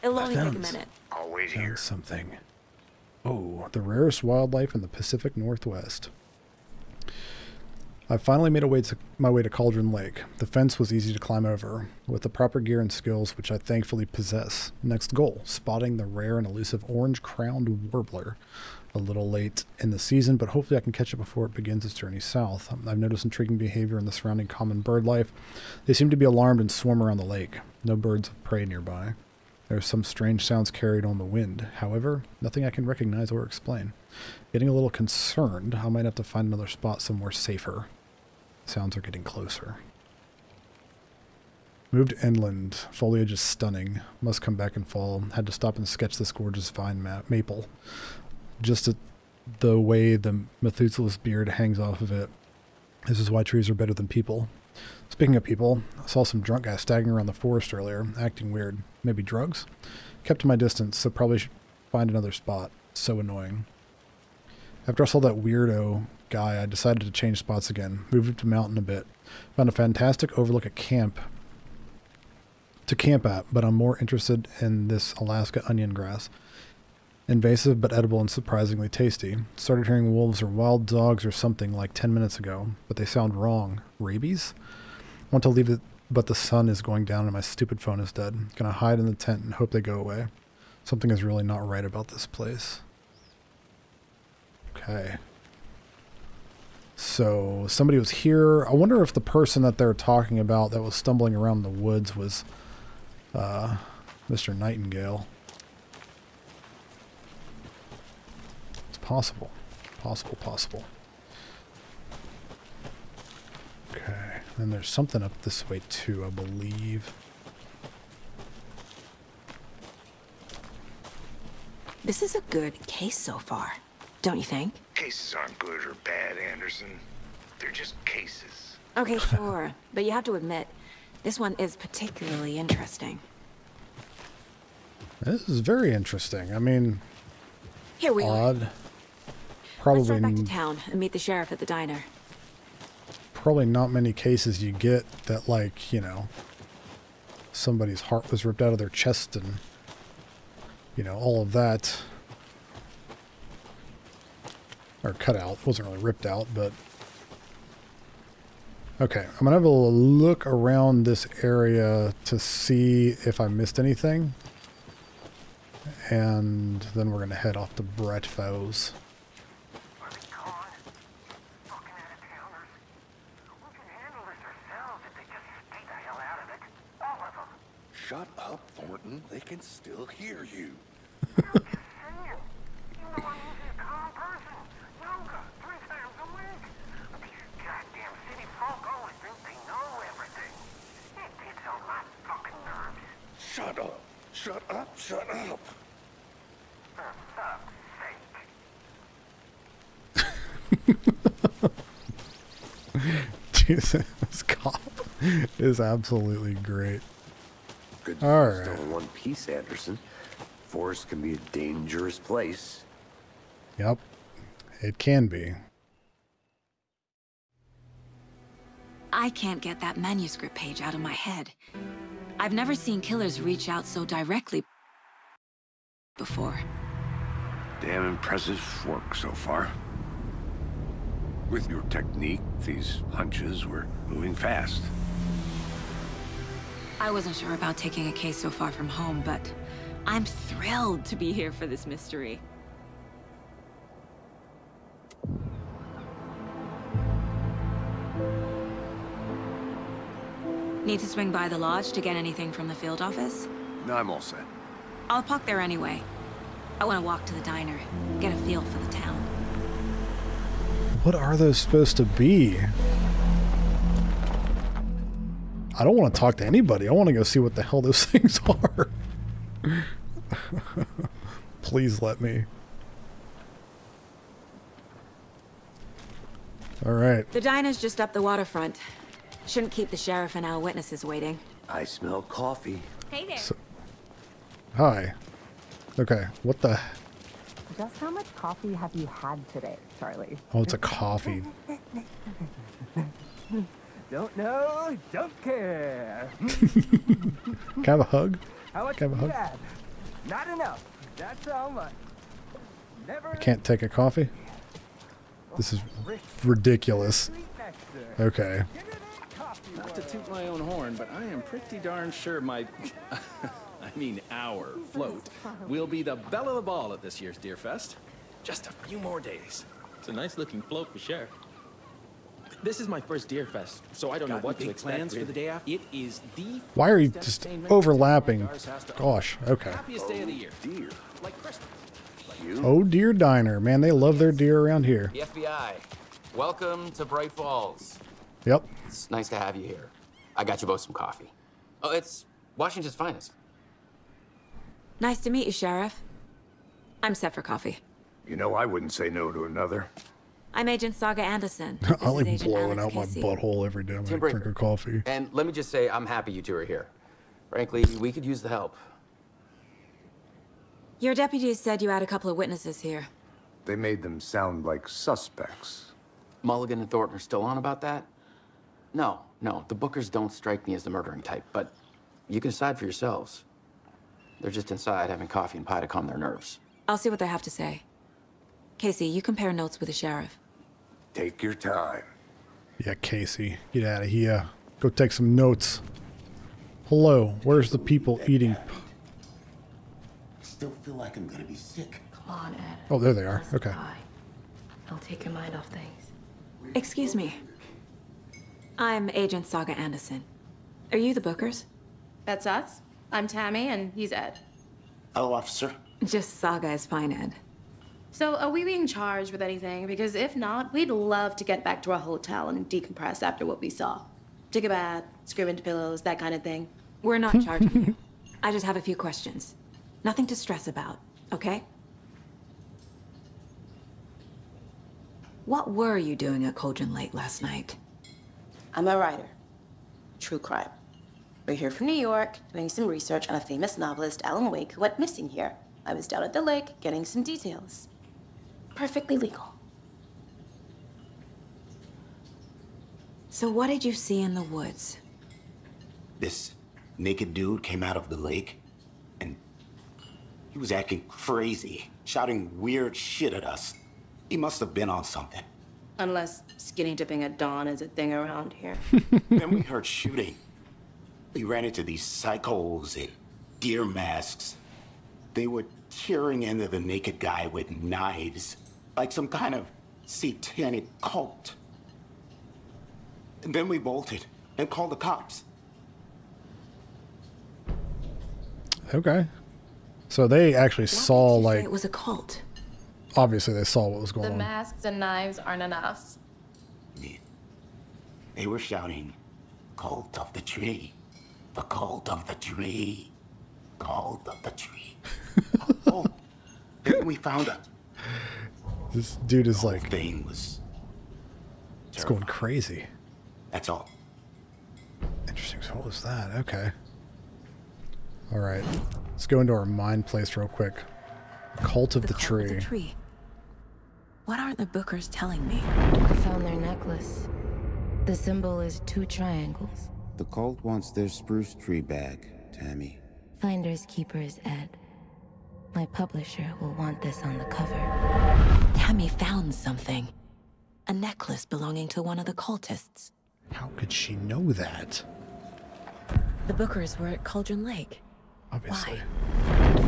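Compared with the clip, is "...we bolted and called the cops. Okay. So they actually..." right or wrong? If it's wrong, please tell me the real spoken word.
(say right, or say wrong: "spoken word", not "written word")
right.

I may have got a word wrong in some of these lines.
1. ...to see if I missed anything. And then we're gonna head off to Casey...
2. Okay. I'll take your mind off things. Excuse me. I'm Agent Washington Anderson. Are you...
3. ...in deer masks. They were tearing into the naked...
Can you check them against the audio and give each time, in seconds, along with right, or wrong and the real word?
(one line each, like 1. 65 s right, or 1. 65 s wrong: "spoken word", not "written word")
1. 162 s wrong: "Bright", not "Casey"
2. 393 s wrong: "Saga", not "Washington"
3. 462 s right.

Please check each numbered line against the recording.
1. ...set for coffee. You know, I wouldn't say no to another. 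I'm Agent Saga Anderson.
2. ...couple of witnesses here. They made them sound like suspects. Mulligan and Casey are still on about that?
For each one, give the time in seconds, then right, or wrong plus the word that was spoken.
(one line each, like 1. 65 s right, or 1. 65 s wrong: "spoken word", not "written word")
1. 347 s right
2. 362 s wrong: "Thornton", not "Casey".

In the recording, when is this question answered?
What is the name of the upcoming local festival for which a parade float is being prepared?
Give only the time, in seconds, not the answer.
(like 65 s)
317 s.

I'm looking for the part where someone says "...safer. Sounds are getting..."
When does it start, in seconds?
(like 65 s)
37 s.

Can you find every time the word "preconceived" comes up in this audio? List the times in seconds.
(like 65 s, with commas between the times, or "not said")
not said.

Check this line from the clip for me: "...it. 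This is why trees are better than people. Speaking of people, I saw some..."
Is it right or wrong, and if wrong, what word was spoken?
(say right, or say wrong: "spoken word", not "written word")
right.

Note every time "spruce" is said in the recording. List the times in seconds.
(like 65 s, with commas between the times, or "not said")
521 s.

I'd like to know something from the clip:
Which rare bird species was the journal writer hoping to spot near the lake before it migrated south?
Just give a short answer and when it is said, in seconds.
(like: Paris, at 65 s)
orange-crowned warbler, at 16 s.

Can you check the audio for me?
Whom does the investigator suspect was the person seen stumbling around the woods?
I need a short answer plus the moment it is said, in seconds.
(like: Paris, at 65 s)
Mr. Nightingale, at 104 s.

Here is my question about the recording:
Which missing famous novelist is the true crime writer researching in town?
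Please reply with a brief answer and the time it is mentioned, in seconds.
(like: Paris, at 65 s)
Alan Wake, at 434 s.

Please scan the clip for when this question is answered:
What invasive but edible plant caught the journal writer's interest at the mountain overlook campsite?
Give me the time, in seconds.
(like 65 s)
75 s.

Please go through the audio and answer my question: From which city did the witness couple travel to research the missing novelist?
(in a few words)
New York.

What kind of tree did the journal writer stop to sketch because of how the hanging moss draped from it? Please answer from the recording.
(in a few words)
vine maple.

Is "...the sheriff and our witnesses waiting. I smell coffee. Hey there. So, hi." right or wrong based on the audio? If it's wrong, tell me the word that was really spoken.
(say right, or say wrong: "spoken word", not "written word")
right.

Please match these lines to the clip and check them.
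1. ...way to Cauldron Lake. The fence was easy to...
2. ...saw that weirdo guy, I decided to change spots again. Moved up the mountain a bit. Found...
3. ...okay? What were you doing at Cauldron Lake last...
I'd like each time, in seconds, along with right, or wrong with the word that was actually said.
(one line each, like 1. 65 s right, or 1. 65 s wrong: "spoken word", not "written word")
1. 9 s right
2. 65 s right
3. 421 s right.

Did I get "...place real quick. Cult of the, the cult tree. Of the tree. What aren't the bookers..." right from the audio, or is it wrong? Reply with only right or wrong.
right.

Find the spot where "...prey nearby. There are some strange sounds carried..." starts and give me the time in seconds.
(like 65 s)
28 s.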